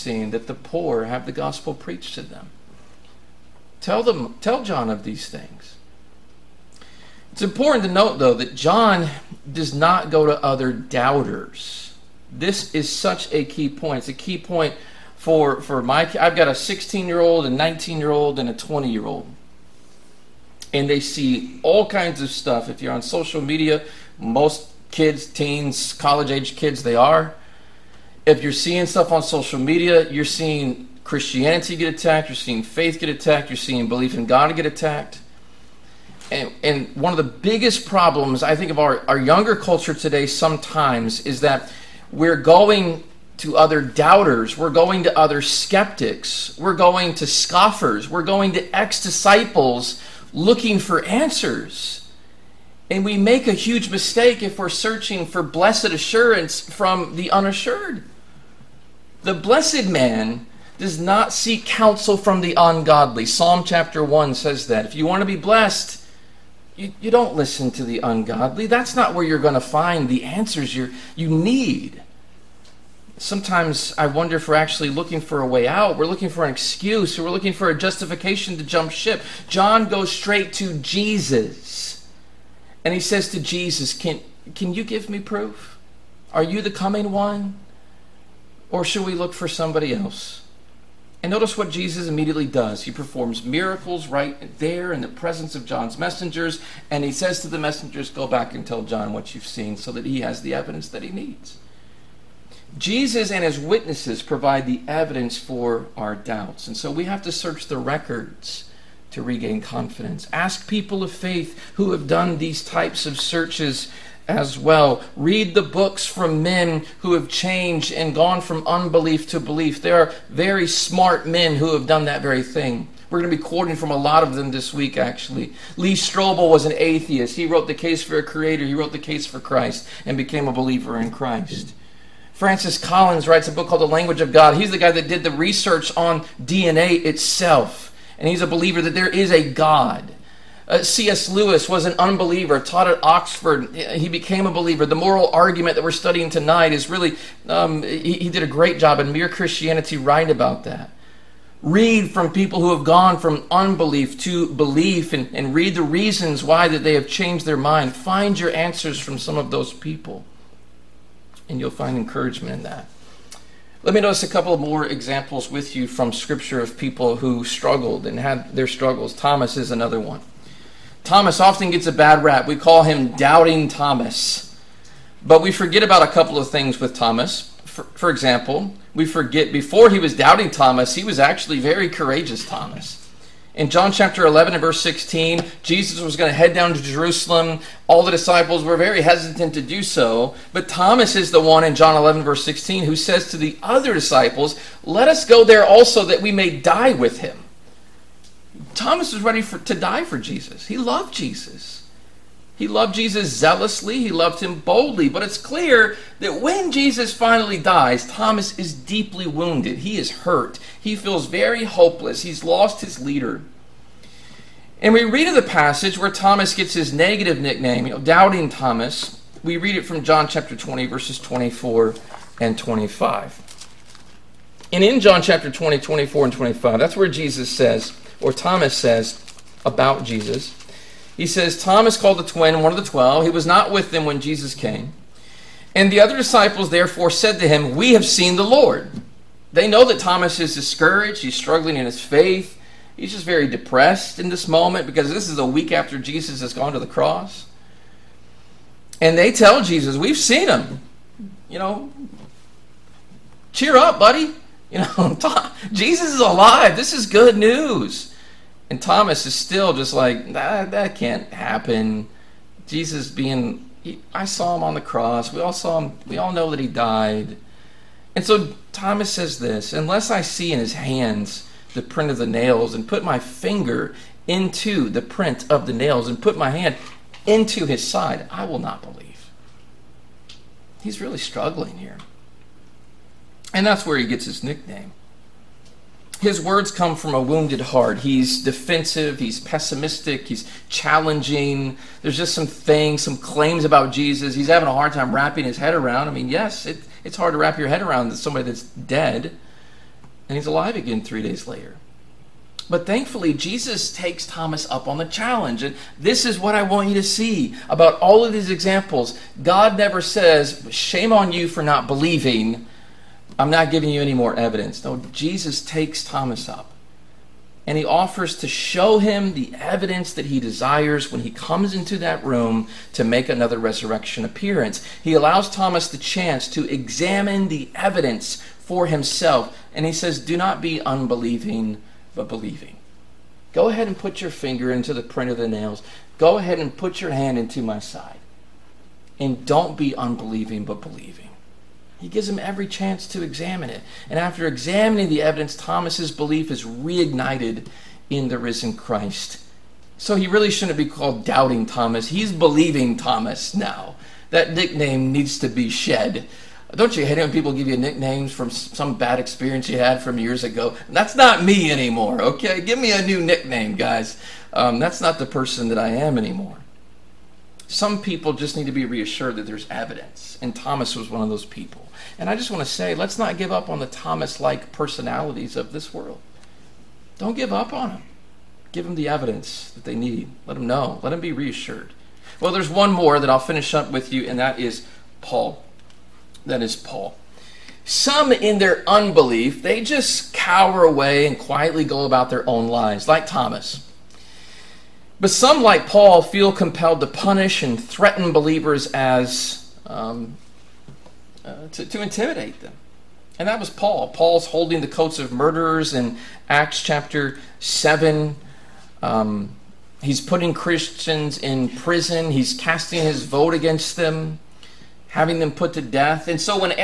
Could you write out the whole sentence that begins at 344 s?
And after examining the evidence, Thomas's belief is reignited in the risen Christ.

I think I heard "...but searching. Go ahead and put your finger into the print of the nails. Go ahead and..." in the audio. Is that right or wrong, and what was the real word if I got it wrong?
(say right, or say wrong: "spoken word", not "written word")
wrong: "believing", not "searching".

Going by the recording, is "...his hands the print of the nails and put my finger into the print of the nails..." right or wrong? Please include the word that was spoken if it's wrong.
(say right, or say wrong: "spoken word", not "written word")
right.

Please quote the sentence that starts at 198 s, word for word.
Thomas was ready for, to die for Jesus.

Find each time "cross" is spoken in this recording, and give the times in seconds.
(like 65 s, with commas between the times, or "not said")
246 s, 264 s.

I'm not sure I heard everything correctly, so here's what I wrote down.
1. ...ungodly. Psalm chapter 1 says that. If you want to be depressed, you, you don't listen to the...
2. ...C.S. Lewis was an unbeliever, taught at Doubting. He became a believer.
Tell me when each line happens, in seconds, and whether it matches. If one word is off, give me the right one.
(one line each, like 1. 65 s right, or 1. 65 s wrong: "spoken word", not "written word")
1. 62 s wrong: "blessed", not "depressed"
2. 140 s wrong: "Oxford", not "Doubting".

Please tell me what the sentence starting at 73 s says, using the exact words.
Sometimes I wonder if we're actually looking for a way out.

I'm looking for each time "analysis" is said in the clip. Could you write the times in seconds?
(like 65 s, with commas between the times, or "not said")
not said.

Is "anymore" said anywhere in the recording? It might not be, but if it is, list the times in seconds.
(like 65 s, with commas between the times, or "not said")
361 s, 366 s.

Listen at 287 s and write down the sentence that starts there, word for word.
He's defensive, he's pessimistic, he's challenging.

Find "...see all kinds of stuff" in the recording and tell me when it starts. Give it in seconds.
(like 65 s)
20 s.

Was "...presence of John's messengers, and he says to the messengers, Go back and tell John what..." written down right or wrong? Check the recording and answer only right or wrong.
right.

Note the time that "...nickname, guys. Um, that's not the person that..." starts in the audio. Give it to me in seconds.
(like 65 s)
363 s.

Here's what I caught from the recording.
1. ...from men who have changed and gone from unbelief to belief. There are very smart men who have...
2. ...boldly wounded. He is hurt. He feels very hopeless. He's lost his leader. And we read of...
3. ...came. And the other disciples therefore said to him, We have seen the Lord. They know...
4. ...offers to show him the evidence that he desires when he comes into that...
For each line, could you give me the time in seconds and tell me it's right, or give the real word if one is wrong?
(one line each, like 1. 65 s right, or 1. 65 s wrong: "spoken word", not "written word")
1. 116 s right
2. 208 s wrong: "deeply", not "boldly"
3. 234 s right
4. 317 s right.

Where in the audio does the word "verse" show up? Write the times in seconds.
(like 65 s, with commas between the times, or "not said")
184 s, 192 s, 220 s.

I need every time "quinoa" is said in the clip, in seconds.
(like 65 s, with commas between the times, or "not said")
not said.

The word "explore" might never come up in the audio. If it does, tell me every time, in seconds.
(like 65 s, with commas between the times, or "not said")
not said.